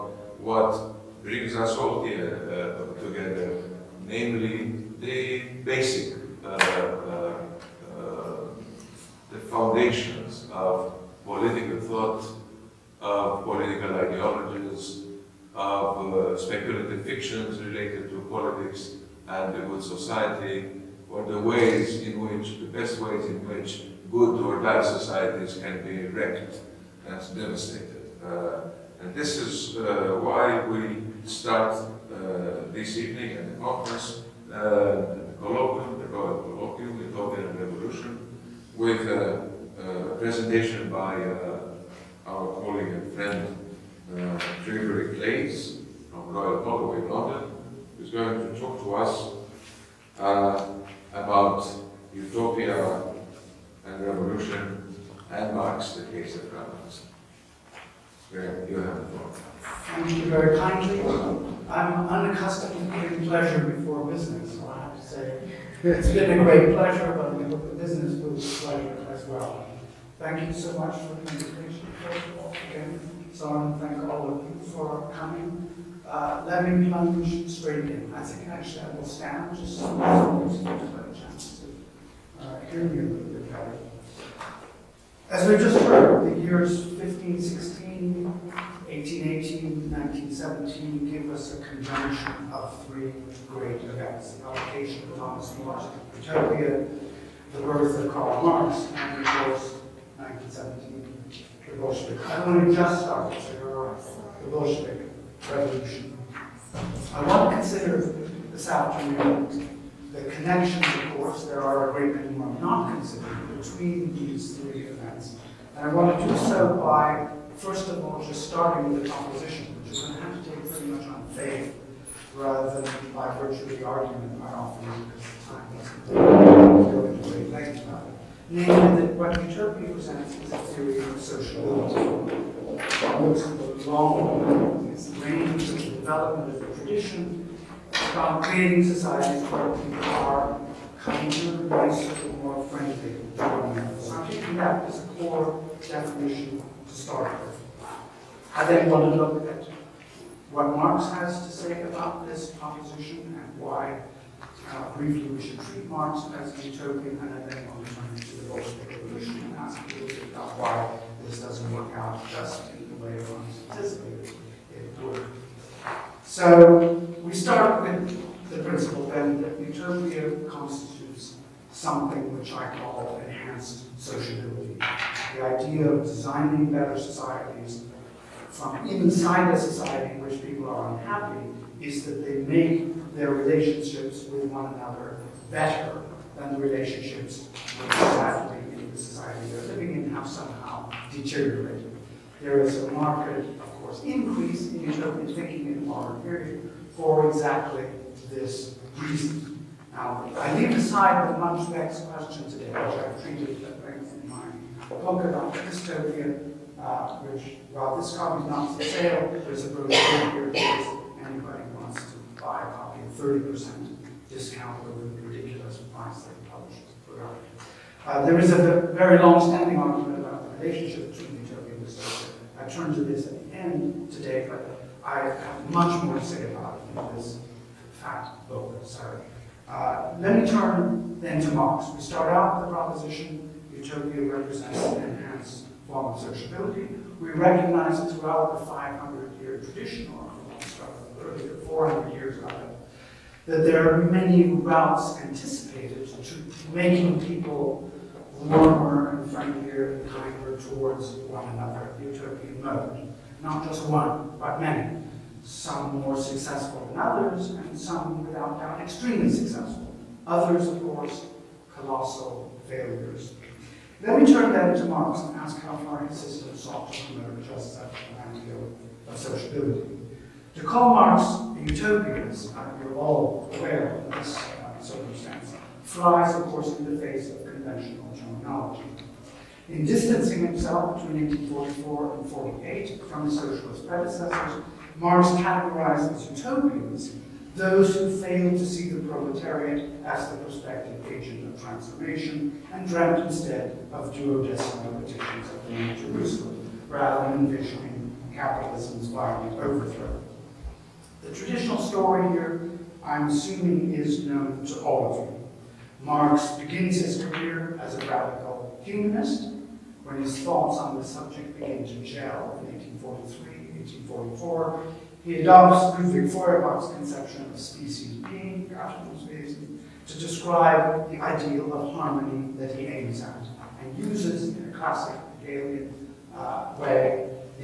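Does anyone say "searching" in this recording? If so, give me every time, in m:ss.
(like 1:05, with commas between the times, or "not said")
not said.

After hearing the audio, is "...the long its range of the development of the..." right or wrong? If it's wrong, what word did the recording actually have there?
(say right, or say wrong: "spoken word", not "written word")
right.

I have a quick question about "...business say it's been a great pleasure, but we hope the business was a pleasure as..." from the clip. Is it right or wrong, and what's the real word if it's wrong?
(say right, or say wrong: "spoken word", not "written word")
right.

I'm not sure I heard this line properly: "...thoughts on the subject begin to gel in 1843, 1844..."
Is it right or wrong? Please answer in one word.
right.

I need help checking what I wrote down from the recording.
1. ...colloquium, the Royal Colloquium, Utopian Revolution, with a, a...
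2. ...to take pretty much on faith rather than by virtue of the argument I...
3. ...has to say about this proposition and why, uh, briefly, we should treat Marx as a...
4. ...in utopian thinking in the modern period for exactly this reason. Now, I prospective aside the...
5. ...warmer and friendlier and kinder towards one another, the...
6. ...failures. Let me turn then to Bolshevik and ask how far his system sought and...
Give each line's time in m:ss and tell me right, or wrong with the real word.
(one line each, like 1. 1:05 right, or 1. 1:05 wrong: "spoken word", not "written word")
1. 0:35 right
2. 2:00 right
3. 2:31 right
4. 3:14 wrong: "leave", not "prospective"
5. 4:08 right
6. 4:22 wrong: "Marx", not "Bolshevik".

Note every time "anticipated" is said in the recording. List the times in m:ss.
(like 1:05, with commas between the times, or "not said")
2:43, 4:05.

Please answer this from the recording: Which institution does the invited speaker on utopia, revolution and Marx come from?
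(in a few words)
Royal Holloway London.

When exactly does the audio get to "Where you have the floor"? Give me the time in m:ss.
0:58.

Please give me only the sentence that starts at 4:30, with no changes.
To call Marx a utopian, and you're all aware of this uh, circumstance, flies, of course, in the face of conventional terminology.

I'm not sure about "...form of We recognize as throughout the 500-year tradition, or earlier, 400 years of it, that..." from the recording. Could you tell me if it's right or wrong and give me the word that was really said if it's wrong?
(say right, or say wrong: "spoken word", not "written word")
right.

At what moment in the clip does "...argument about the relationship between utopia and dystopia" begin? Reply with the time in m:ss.
3:39.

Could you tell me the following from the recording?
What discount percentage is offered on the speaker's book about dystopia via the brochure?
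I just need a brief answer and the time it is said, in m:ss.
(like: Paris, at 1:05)
30%, at 3:33.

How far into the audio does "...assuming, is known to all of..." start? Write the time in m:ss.
5:03.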